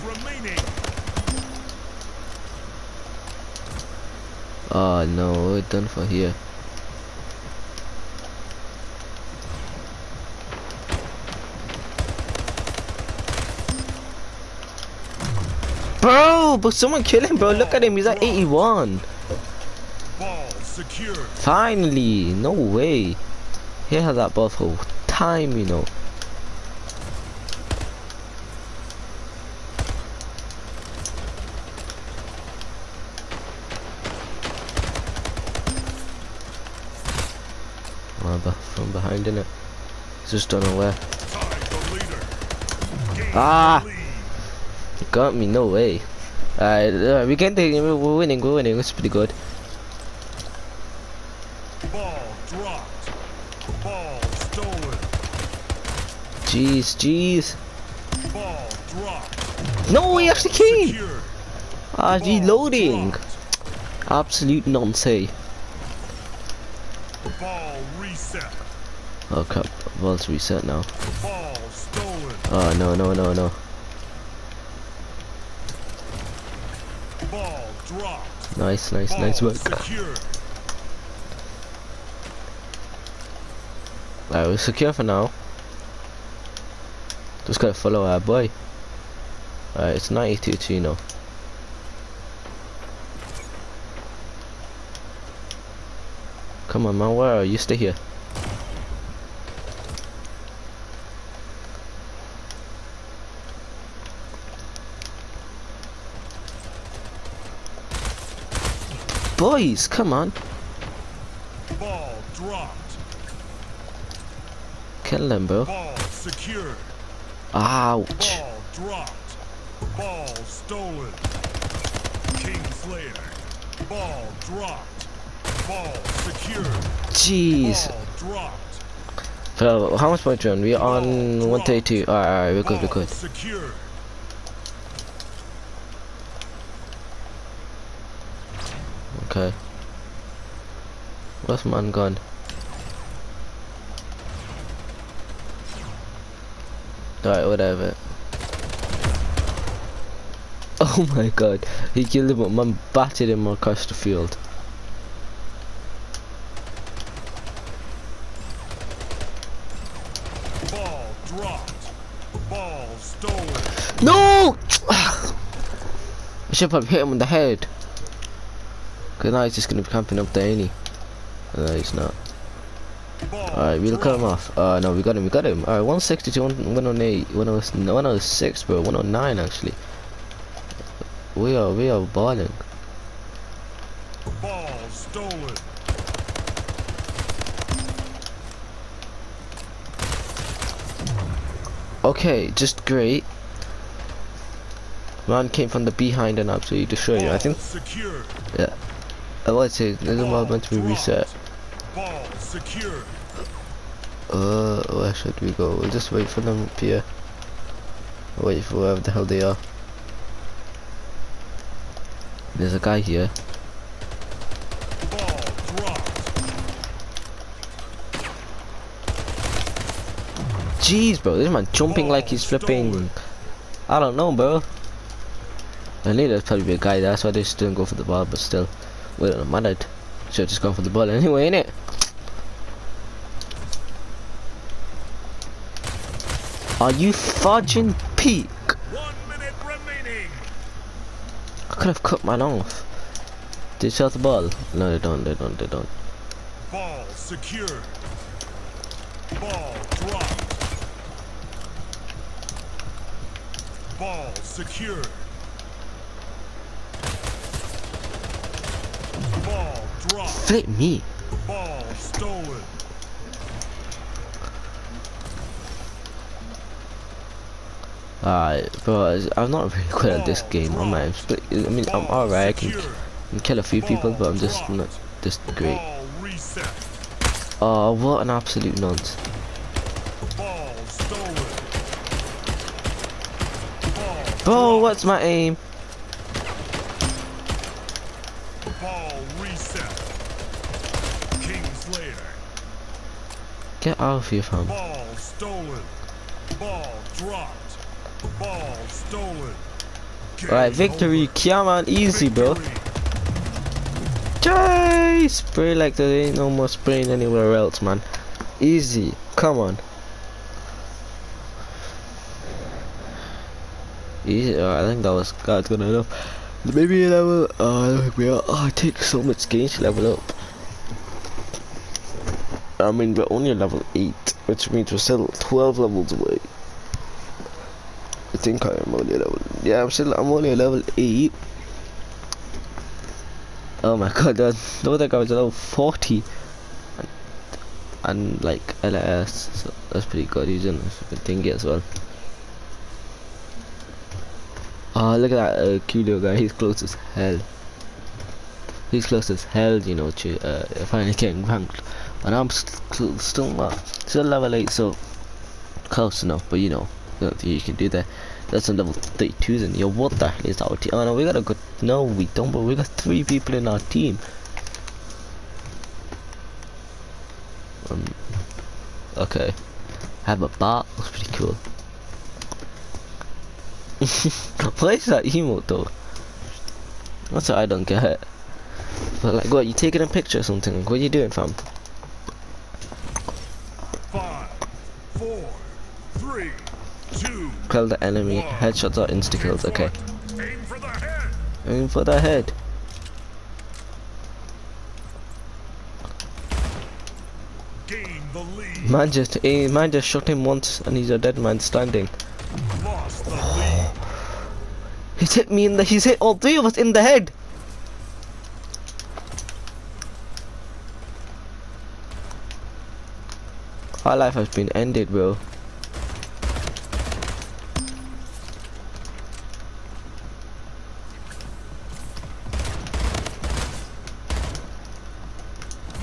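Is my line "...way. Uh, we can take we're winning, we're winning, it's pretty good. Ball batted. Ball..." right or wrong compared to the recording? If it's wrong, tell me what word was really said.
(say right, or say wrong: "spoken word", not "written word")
wrong: "dropped", not "batted".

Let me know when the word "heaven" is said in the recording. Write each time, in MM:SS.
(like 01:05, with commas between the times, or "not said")
not said.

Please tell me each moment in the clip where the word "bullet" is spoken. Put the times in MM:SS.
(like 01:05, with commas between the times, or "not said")
03:50.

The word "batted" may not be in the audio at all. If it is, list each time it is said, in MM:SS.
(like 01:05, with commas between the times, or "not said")
02:32.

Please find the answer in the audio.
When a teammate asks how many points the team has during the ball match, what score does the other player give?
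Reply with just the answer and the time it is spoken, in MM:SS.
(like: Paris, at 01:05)
132, at 02:10.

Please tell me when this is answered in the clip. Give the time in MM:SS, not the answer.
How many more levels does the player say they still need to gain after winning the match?
05:25.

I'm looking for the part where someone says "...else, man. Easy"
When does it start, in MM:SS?
05:07.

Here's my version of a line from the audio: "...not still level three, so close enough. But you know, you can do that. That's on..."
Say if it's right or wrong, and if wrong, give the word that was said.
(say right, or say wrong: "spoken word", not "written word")
wrong: "eight", not "three".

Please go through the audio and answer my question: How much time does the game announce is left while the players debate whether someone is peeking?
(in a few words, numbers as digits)
One minute.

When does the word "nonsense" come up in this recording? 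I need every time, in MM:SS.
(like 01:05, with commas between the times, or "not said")
01:04.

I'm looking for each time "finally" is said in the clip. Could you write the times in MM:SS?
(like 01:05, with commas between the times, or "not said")
00:21, 05:50.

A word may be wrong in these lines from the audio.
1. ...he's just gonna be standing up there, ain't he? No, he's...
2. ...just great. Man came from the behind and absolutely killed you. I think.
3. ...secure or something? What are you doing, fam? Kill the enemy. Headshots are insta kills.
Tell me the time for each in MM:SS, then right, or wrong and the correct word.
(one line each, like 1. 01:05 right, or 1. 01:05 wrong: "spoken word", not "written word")
1. 02:49 wrong: "camping", not "standing"
2. 03:12 wrong: "destroyed", not "killed"
3. 06:20 wrong: "picture", not "secure".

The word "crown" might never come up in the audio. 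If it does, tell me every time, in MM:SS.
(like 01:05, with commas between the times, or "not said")
not said.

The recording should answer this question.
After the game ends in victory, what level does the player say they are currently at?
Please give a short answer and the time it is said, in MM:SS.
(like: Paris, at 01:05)
8, at 05:23.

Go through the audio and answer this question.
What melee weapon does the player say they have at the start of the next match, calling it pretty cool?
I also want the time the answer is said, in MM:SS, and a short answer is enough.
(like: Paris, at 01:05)
a bat, at 06:10.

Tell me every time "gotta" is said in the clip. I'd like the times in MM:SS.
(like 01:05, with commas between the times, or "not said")
01:27.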